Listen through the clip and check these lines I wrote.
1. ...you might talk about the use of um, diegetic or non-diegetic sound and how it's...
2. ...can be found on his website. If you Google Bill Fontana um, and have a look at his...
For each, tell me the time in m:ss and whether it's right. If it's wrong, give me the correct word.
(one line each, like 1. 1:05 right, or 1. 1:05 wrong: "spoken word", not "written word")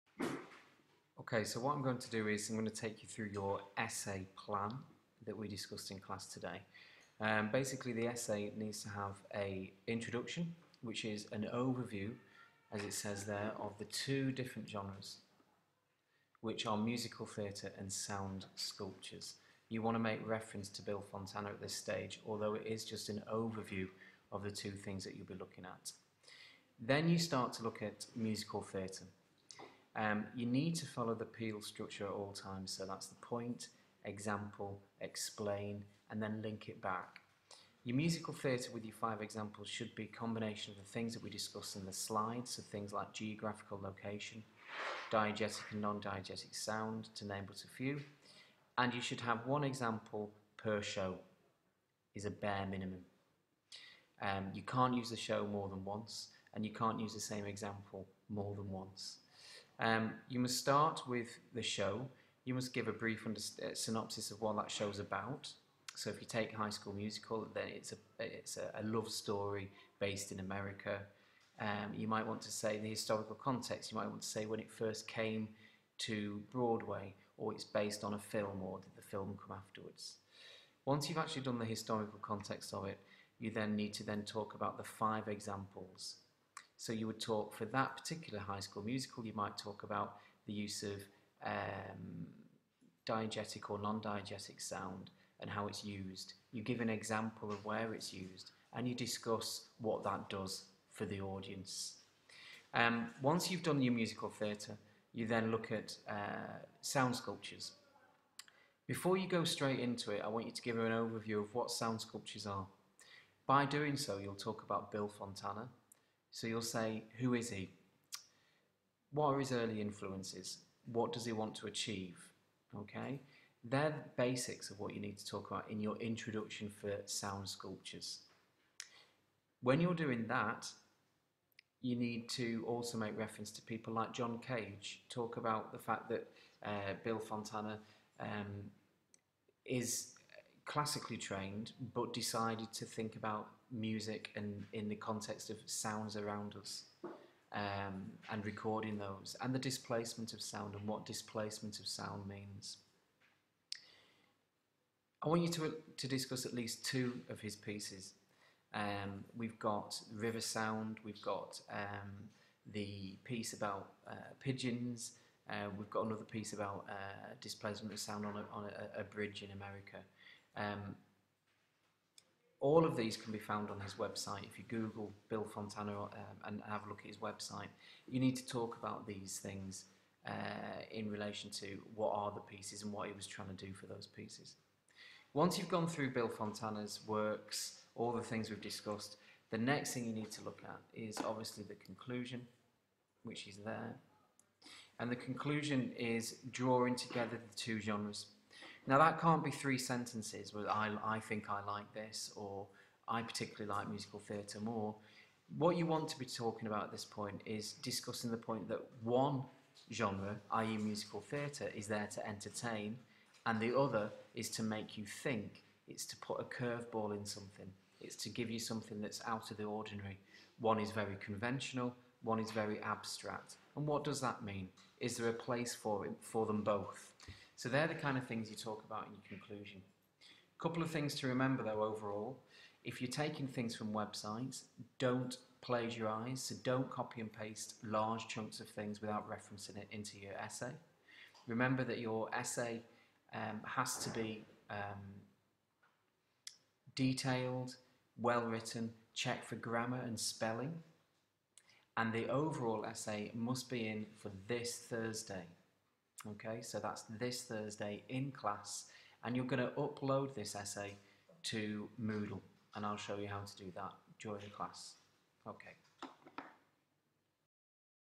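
1. 1:29 right
2. 2:53 right.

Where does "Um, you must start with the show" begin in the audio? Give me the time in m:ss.
0:59.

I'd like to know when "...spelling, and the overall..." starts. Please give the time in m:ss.
4:10.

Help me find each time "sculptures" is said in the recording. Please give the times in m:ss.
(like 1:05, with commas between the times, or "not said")
0:18, 1:47, 1:52, 2:07.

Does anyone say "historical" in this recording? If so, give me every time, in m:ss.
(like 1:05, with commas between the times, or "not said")
1:12, 1:21.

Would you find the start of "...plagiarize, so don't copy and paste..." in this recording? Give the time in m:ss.
3:55.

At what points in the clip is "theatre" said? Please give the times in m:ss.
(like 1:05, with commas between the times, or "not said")
0:17, 0:28, 0:38, 1:44, 3:24, 3:31.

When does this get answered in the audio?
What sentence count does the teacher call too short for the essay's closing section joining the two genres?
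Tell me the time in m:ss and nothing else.
3:19.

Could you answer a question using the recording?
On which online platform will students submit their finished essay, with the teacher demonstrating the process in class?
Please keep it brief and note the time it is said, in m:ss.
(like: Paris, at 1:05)
Moodle, at 4:21.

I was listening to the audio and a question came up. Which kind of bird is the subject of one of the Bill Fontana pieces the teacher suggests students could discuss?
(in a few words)
pigeons.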